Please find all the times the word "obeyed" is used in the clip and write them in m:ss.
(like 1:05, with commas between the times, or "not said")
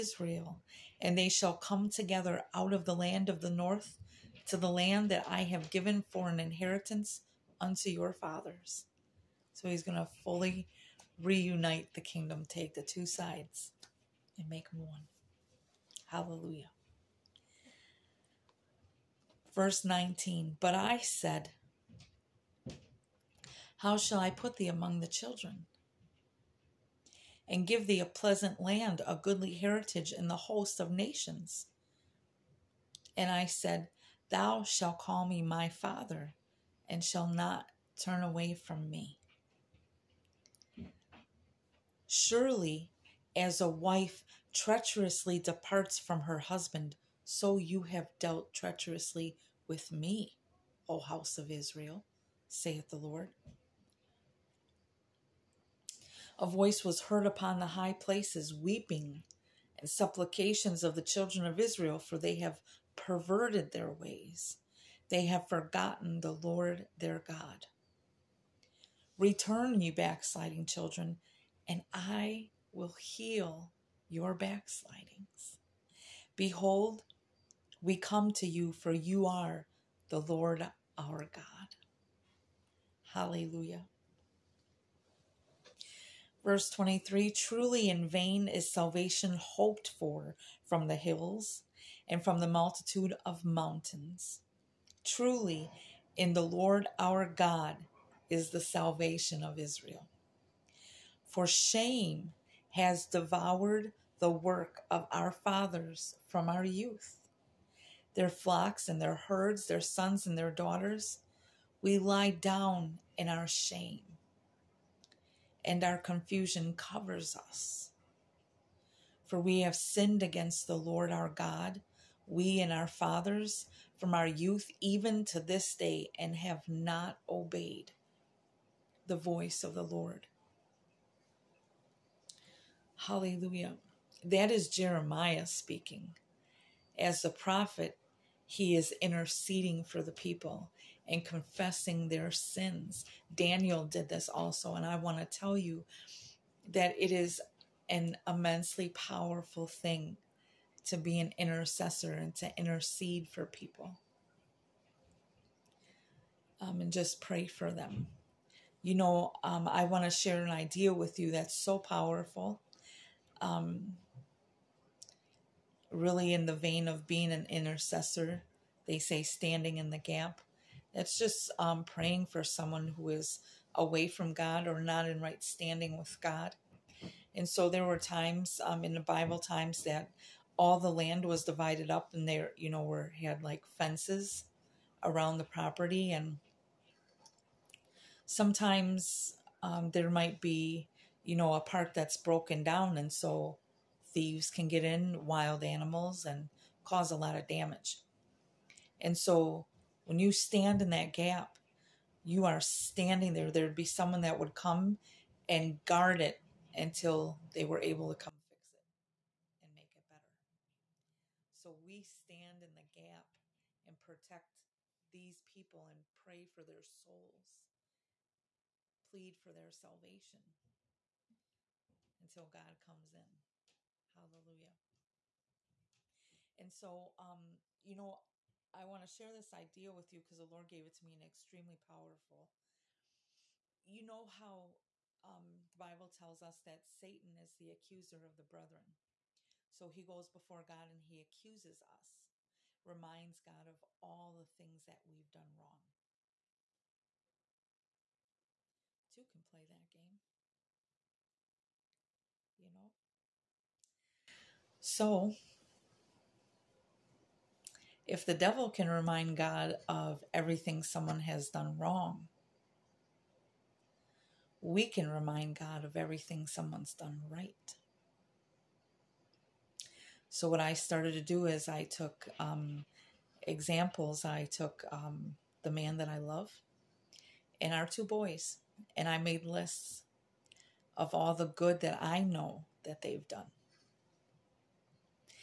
2:07.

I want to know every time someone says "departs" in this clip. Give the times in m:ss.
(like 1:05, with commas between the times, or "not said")
0:45.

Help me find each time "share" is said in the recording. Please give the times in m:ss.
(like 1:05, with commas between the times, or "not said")
2:40, 3:49.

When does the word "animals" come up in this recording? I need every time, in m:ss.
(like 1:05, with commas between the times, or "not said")
3:15.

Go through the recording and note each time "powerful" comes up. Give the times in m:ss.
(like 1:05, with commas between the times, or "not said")
2:28, 2:41, 3:51.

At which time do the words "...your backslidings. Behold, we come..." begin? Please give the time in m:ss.
1:14.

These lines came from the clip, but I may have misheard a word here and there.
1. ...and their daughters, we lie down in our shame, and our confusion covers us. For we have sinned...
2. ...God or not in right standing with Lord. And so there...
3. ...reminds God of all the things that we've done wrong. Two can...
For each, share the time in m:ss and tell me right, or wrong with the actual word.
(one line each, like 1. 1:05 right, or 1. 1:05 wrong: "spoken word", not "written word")
1. 1:50 right
2. 2:54 wrong: "God", not "Lord"
3. 4:02 right.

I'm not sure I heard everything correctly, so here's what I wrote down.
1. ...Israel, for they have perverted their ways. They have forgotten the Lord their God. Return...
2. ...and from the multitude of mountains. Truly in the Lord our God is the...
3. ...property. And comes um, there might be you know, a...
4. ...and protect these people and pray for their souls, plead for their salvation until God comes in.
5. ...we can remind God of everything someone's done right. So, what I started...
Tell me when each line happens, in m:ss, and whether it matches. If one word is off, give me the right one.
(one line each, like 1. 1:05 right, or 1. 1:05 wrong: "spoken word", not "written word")
1. 1:01 right
2. 1:32 right
3. 3:05 wrong: "sometimes", not "comes"
4. 3:33 right
5. 4:24 right.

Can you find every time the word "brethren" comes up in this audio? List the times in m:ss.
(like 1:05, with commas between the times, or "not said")
3:58.